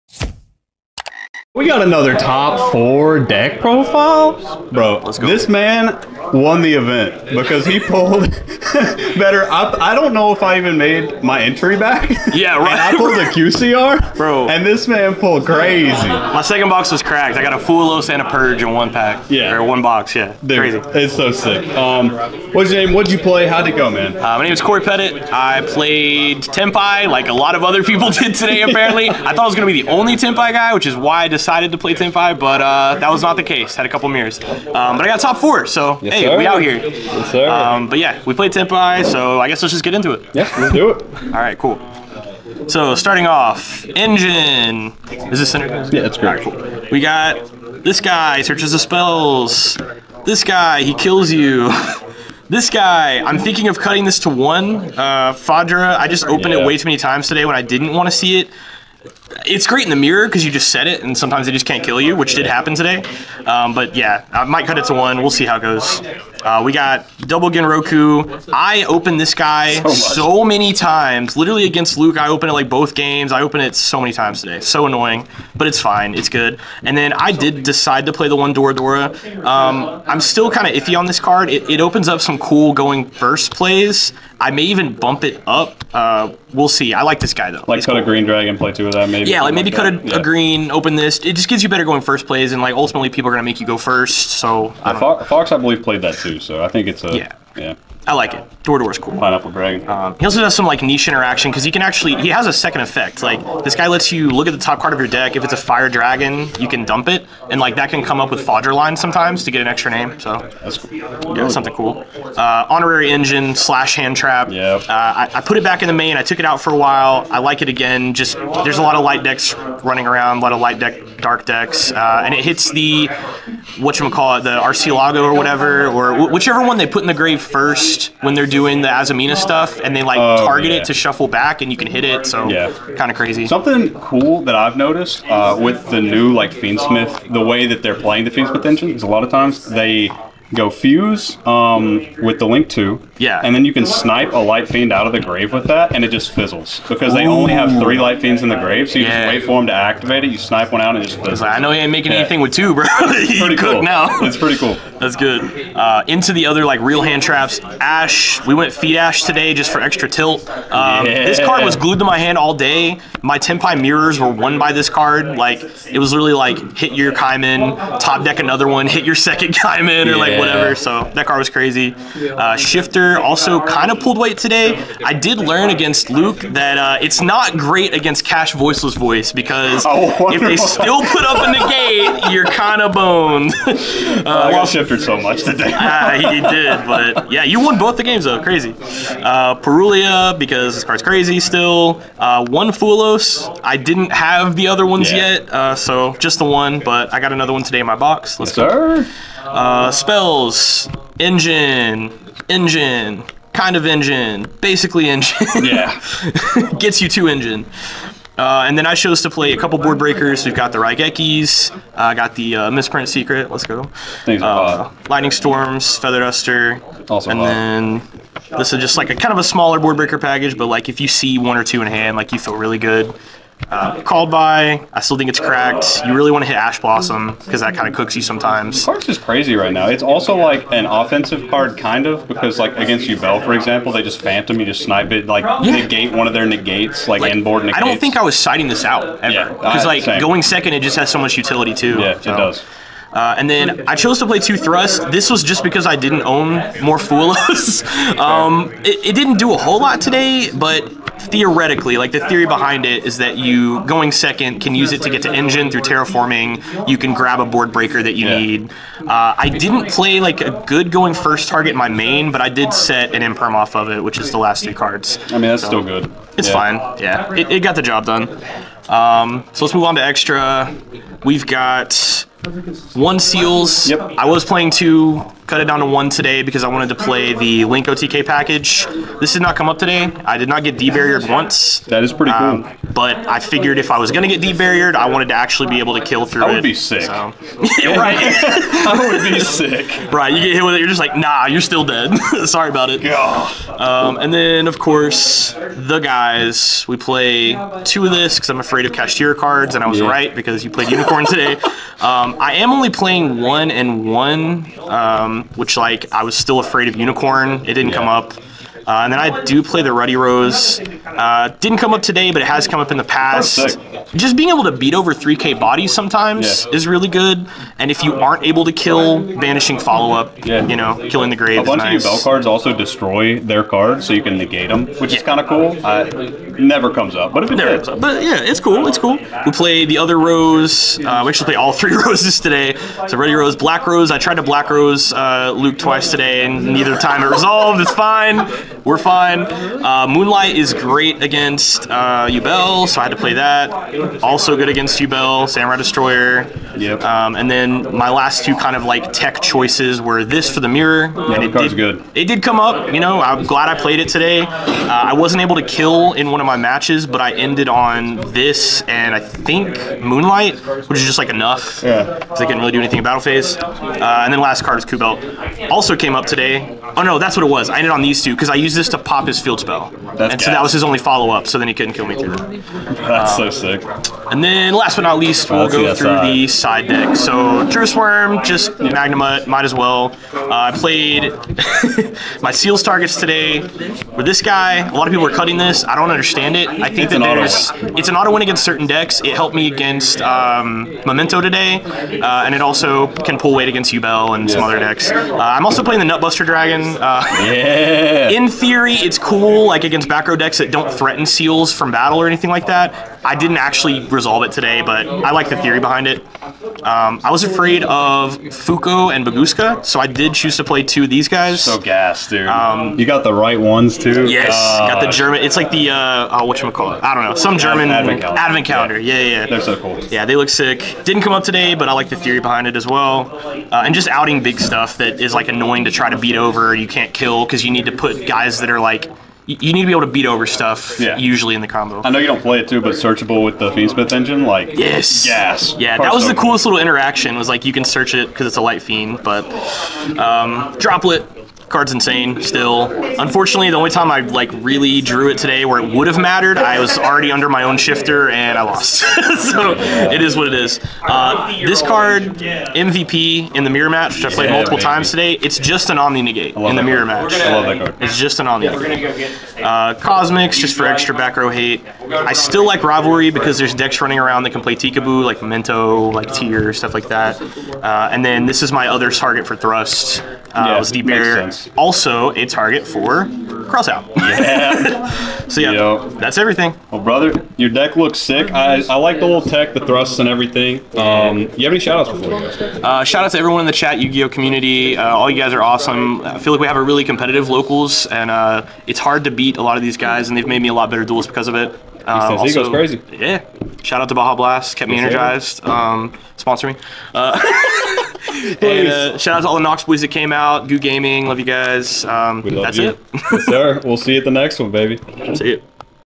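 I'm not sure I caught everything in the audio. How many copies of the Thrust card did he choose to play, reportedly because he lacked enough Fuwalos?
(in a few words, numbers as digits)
2.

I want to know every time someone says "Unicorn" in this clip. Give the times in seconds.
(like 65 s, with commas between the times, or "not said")
300 s, 306 s.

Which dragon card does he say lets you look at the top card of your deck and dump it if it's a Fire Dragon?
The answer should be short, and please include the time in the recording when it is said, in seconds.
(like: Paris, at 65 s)
Pineapple Dragon, at 99 s.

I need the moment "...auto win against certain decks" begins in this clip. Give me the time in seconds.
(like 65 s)
388 s.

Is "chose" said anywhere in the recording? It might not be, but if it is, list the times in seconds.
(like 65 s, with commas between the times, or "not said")
208 s, 243 s.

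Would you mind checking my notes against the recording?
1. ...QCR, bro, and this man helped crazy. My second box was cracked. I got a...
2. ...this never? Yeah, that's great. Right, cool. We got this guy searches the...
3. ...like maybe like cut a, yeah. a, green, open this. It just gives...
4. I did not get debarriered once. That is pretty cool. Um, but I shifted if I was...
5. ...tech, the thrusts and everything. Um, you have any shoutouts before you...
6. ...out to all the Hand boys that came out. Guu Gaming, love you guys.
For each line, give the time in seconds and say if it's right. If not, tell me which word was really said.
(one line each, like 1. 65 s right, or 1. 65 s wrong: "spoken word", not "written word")
1. 13 s wrong: "pulled", not "helped"
2. 45 s wrong: "center", not "never"
3. 89 s right
4. 280 s wrong: "figured", not "shifted"
5. 479 s right
6. 499 s wrong: "Knox", not "Hand".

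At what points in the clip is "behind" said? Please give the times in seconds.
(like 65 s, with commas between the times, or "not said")
252 s, 405 s, 422 s.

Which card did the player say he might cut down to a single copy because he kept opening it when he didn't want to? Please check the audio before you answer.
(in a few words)
Fadra.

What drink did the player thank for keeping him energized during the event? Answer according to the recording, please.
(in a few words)
Baja Blast.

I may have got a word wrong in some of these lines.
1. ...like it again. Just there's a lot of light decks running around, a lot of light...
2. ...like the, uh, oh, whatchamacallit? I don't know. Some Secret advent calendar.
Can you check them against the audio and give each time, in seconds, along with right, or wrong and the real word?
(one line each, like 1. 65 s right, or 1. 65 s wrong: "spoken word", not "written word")
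1. 117 s right
2. 415 s wrong: "German", not "Secret".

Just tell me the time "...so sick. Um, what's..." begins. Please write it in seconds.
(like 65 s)
21 s.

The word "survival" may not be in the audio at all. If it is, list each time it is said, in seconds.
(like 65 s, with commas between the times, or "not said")
not said.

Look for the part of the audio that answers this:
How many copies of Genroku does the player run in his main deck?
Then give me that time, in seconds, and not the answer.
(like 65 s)
67 s.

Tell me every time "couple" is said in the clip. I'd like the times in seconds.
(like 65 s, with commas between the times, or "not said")
33 s, 209 s.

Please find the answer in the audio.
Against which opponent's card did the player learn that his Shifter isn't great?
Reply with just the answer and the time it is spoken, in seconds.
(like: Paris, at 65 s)
Voiceless Voice, at 178 s.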